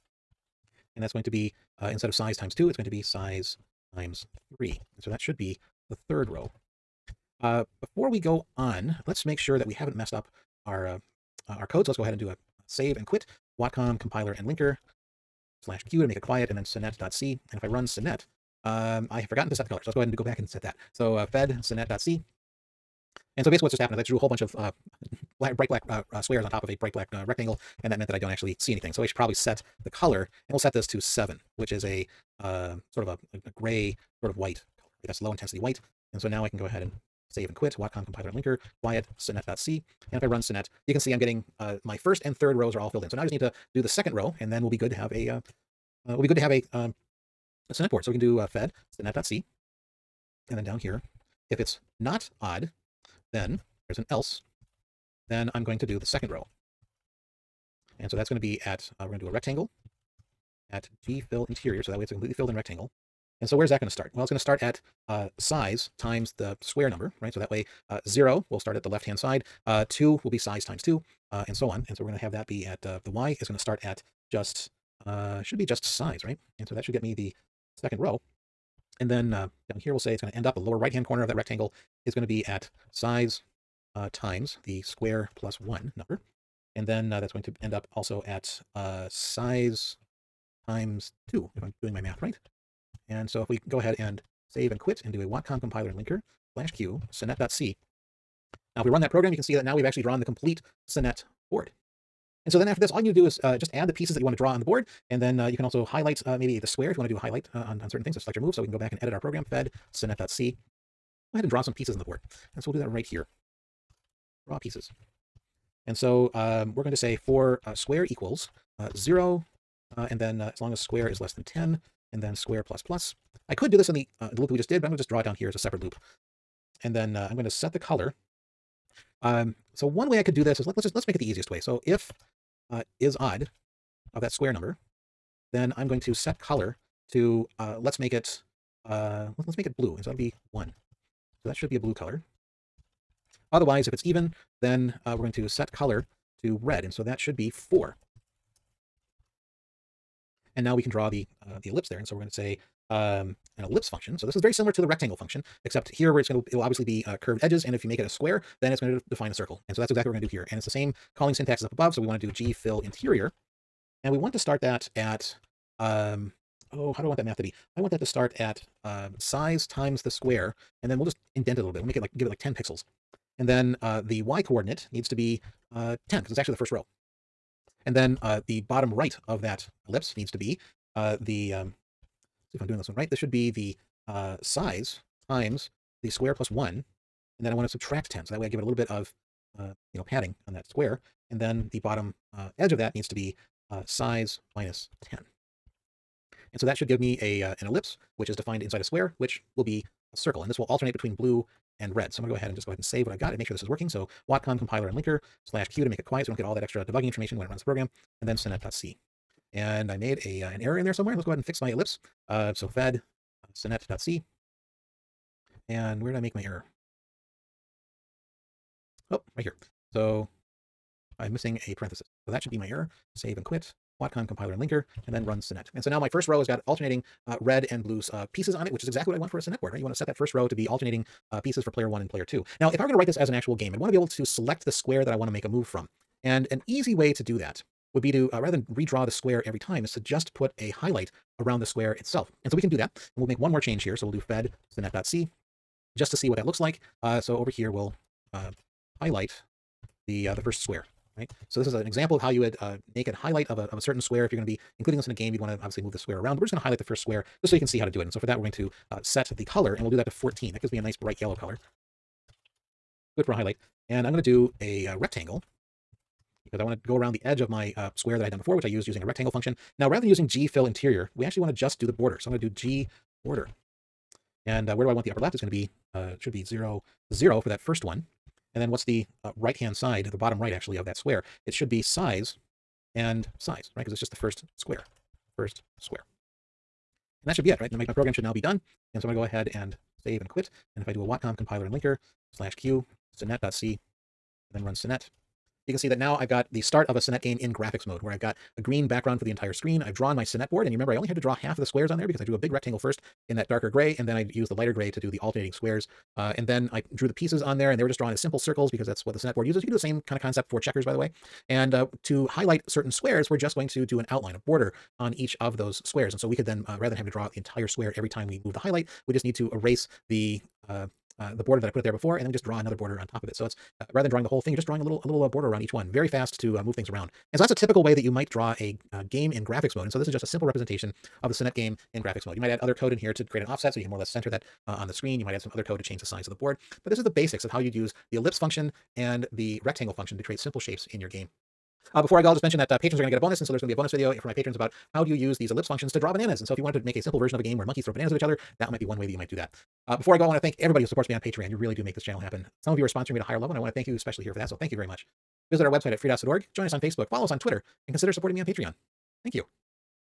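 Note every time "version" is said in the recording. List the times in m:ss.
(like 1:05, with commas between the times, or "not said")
5:47.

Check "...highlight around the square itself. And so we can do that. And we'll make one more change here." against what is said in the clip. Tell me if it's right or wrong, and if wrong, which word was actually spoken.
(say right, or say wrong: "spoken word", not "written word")
right.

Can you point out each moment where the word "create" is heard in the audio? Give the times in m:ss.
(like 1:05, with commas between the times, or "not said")
5:33, 5:40.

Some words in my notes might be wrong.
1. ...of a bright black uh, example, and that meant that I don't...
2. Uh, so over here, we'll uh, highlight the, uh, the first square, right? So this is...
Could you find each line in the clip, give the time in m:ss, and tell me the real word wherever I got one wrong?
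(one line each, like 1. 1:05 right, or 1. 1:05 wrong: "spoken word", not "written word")
1. 0:26 wrong: "rectangle", not "example"
2. 4:07 right.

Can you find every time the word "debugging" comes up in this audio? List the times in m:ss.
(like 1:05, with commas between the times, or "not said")
3:26.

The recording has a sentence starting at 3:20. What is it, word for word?
And this will alternate between blue and red.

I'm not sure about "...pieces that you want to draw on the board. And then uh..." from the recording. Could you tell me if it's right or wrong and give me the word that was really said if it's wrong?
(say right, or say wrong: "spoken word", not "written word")
right.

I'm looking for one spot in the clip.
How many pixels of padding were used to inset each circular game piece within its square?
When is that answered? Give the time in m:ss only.
2:52.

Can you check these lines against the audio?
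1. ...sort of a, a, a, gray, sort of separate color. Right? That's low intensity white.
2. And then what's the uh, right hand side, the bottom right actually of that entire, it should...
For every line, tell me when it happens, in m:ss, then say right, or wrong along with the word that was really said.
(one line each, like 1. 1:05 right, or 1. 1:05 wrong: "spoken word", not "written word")
1. 0:32 wrong: "white", not "separate"
2. 4:38 wrong: "square", not "entire".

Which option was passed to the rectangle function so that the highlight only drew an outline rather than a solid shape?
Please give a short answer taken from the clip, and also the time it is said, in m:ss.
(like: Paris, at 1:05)
G border, at 4:32.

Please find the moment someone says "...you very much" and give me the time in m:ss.
5:54.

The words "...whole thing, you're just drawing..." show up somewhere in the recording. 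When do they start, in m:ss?
5:24.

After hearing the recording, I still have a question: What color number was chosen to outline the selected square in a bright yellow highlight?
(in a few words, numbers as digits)
14.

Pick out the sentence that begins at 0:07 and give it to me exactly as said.
Uh, before we go on, let's make sure that we haven't messed up our uh, uh our code.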